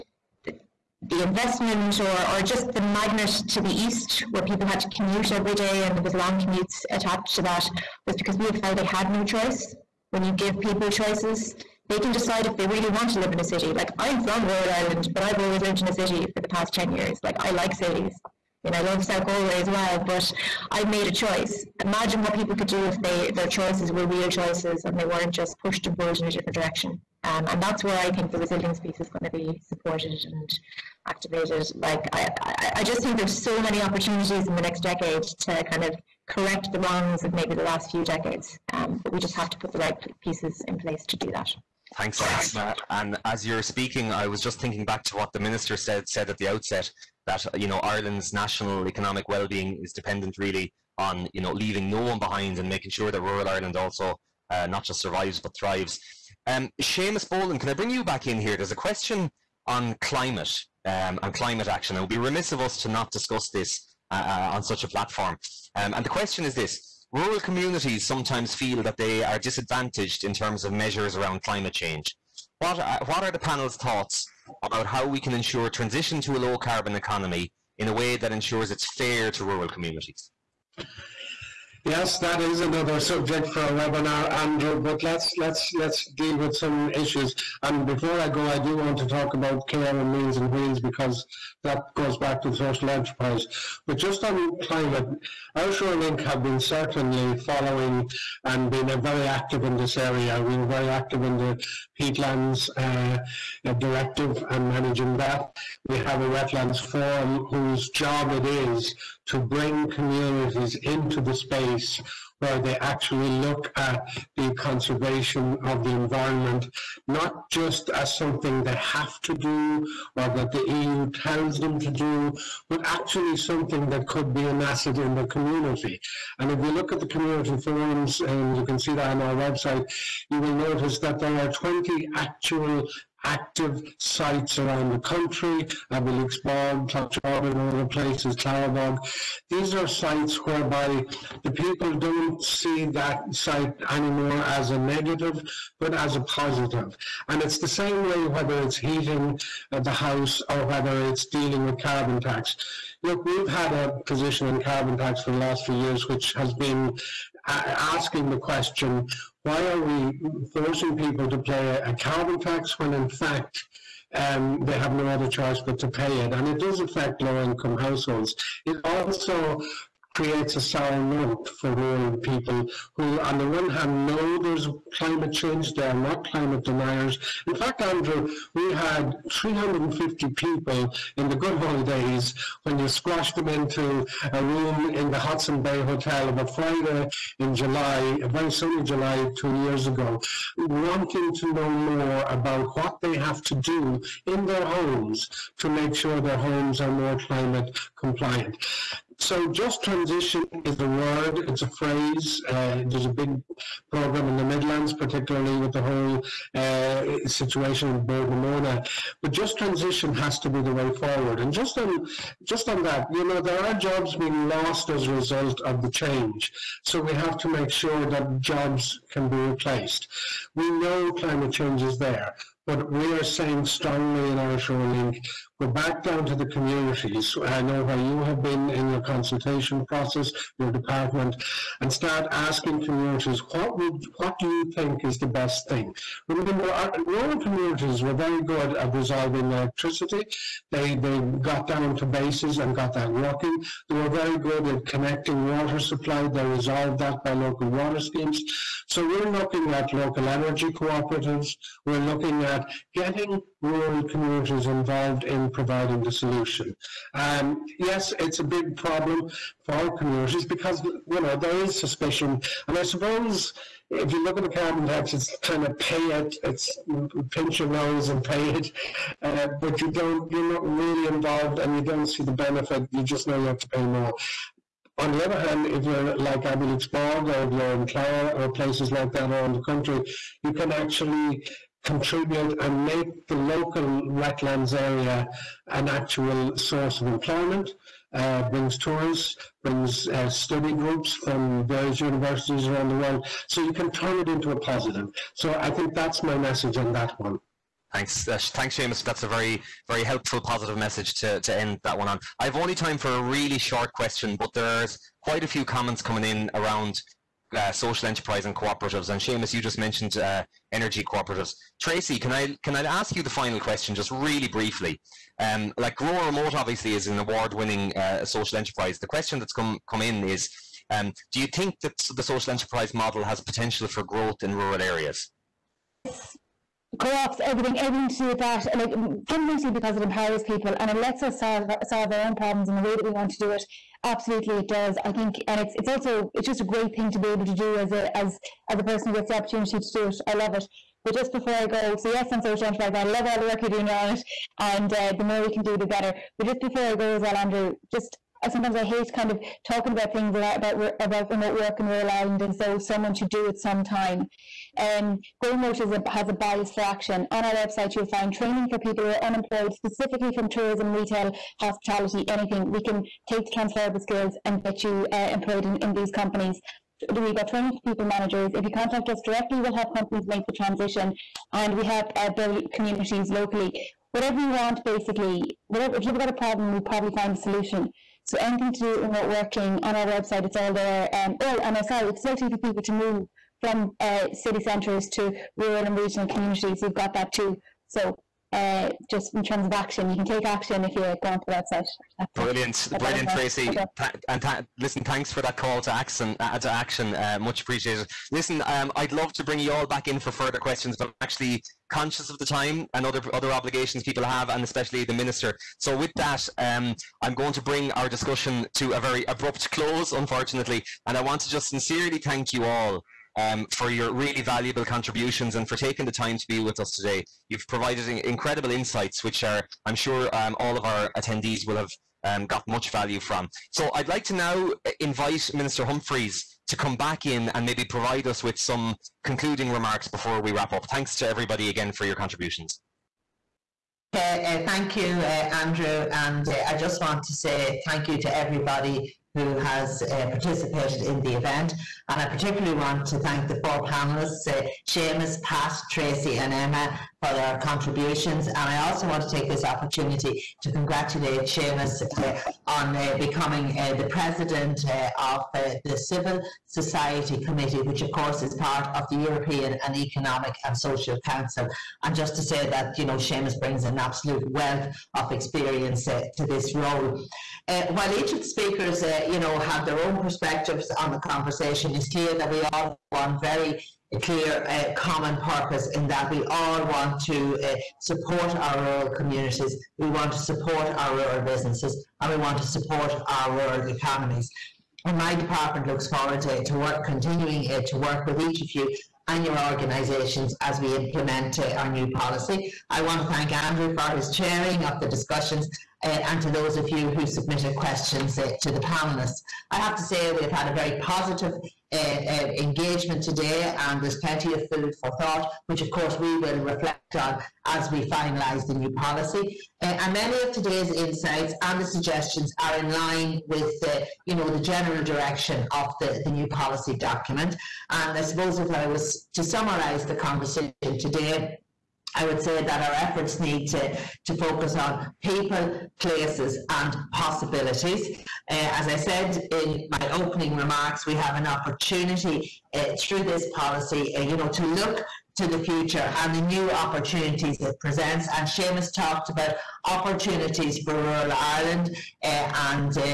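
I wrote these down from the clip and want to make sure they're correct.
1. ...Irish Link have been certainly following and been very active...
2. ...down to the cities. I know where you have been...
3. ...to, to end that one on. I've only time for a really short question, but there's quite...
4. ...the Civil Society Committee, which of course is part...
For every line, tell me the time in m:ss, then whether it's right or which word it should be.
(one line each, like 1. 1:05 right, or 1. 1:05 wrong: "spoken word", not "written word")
1. 1:35 right
2. 3:46 wrong: "communities", not "cities"
3. 5:01 right
4. 7:35 right.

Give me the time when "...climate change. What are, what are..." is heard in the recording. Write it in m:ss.
1:11.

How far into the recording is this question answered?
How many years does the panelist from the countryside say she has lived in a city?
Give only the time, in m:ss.
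0:16.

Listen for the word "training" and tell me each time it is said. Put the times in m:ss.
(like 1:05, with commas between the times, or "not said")
5:58, 6:07.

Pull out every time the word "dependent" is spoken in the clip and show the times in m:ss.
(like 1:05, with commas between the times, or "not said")
0:49.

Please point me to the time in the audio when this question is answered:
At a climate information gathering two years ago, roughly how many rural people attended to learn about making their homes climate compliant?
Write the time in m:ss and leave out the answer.
2:59.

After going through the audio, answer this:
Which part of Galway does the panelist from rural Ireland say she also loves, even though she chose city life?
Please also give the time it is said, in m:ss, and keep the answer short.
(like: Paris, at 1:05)
South Galway, at 0:19.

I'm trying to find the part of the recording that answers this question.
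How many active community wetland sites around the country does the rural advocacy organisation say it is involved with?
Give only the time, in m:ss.
2:11.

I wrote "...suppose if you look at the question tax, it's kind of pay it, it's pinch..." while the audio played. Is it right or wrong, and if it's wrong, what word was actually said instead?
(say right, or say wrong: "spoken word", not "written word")
wrong: "carbon", not "question".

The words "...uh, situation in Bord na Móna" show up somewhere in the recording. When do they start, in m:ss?
3:26.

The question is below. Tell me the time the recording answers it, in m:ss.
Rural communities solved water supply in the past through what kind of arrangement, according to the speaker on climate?
4:07.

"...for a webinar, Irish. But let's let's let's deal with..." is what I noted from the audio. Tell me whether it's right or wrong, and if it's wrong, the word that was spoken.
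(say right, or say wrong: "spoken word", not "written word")
wrong: "Andrew", not "Irish".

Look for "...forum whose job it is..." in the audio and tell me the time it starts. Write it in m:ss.
1:46.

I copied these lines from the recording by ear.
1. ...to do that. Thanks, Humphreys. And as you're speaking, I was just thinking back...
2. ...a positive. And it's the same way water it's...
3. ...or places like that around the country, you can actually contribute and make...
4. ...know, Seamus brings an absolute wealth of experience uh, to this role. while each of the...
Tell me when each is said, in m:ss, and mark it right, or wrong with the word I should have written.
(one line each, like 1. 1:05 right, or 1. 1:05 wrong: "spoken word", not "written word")
1. 0:41 wrong: "Emma", not "Humphreys"
2. 2:26 wrong: "whether", not "water"
3. 4:38 right
4. 7:43 right.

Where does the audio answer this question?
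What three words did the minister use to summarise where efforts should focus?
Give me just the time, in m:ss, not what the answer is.
8:45.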